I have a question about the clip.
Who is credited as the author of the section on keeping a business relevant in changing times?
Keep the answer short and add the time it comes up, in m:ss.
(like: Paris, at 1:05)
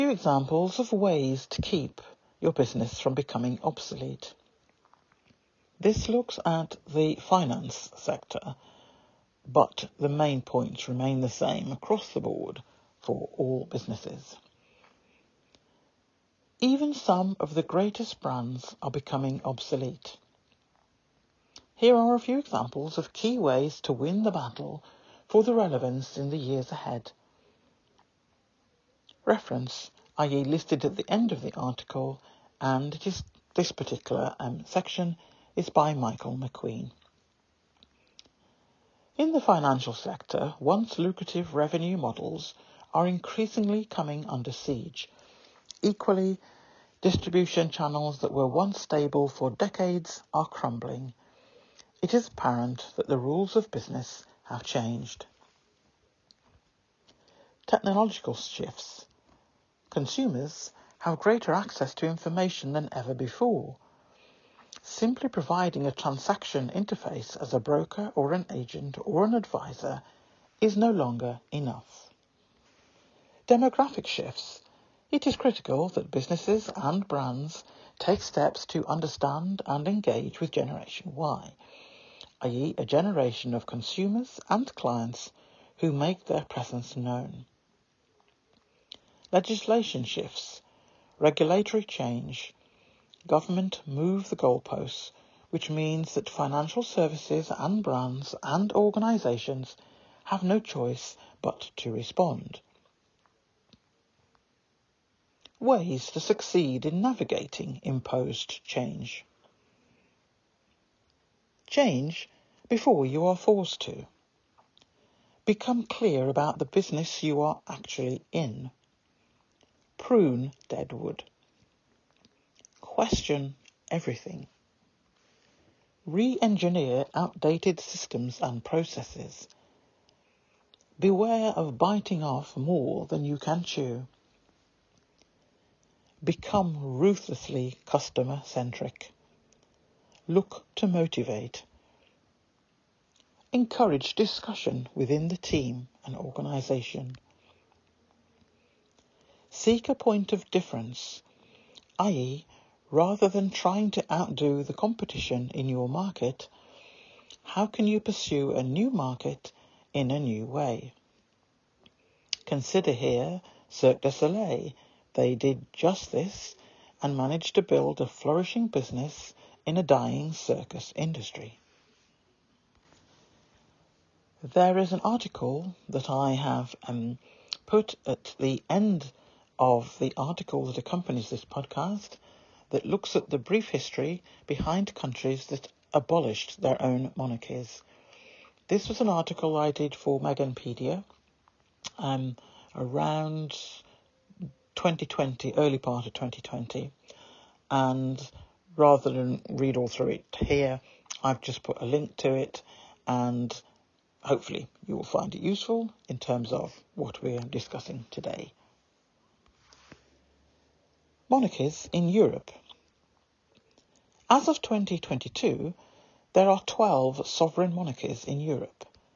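Michael McQueen, at 0:35.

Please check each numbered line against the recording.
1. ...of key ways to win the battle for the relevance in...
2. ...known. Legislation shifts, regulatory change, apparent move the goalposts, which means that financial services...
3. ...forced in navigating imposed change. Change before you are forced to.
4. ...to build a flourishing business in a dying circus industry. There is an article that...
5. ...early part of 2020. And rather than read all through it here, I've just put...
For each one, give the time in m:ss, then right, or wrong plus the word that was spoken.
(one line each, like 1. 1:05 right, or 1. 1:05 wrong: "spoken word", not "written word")
1. 0:22 right
2. 1:26 wrong: "government", not "apparent"
3. 1:46 wrong: "succeed", not "forced"
4. 2:47 right
5. 3:15 right.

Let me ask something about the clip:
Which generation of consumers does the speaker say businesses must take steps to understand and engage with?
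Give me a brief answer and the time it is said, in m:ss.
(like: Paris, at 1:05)
Generation Y, at 1:20.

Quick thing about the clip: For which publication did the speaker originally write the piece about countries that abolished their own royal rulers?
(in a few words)
Meganpedia.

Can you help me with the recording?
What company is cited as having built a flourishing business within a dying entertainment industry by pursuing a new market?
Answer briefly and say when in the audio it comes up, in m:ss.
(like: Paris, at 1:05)
Cirque du Soleil, at 2:43.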